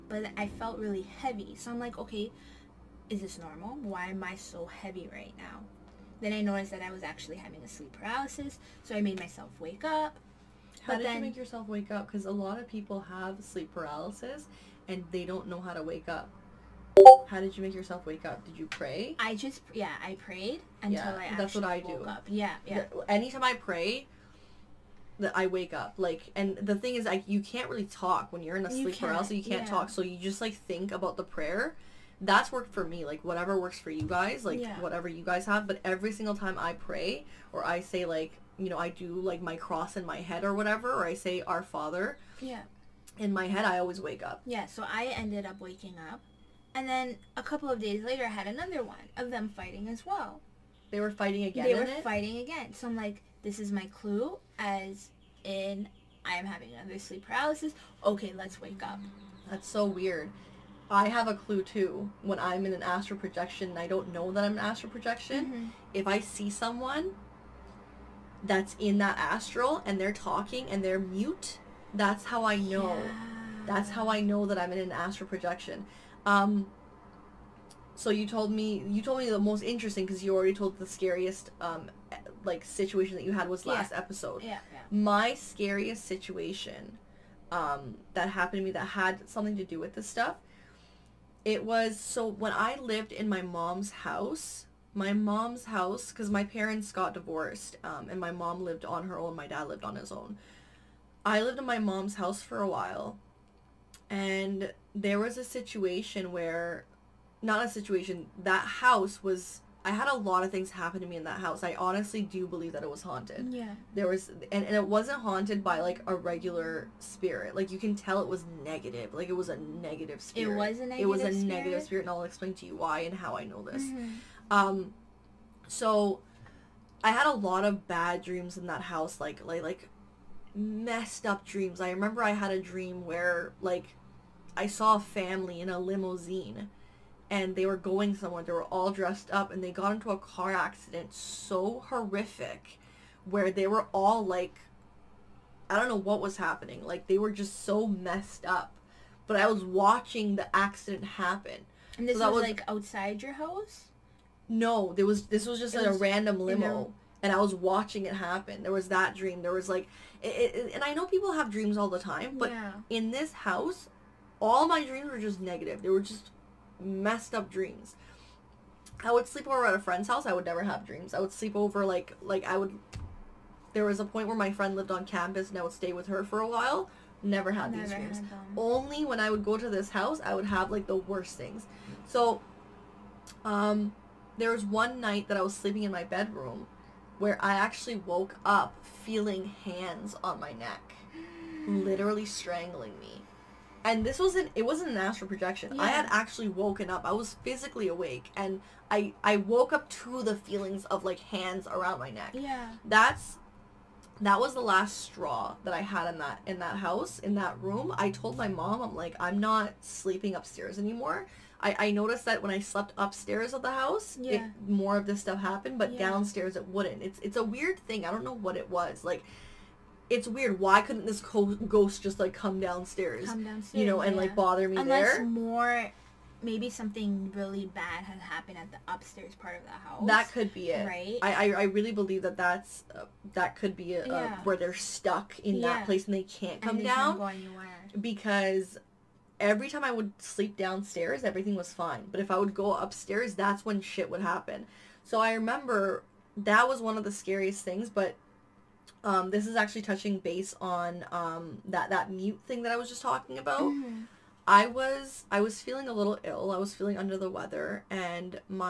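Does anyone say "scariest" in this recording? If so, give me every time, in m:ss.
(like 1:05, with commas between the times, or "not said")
1:20, 1:25, 4:07.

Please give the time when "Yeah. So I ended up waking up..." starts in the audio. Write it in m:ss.
0:44.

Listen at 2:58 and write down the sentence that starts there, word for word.
Had Only when I would go to this house, I would have like the worst things.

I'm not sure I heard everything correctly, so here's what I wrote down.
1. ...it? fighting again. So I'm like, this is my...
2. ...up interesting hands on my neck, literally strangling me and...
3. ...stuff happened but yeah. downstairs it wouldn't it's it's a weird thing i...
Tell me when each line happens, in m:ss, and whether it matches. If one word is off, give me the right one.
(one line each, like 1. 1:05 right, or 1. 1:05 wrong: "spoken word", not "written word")
1. 0:51 right
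2. 3:08 wrong: "feeling", not "interesting"
3. 3:35 right.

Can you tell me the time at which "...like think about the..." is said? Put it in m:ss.
0:30.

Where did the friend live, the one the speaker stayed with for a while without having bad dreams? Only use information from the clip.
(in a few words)
On campus.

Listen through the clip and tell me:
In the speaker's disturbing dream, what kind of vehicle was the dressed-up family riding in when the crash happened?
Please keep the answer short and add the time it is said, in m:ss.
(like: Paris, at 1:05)
Limousine, at 2:15.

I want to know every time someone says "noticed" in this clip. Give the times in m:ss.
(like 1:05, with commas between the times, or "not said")
0:06, 3:31.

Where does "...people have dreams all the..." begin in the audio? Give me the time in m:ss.
2:41.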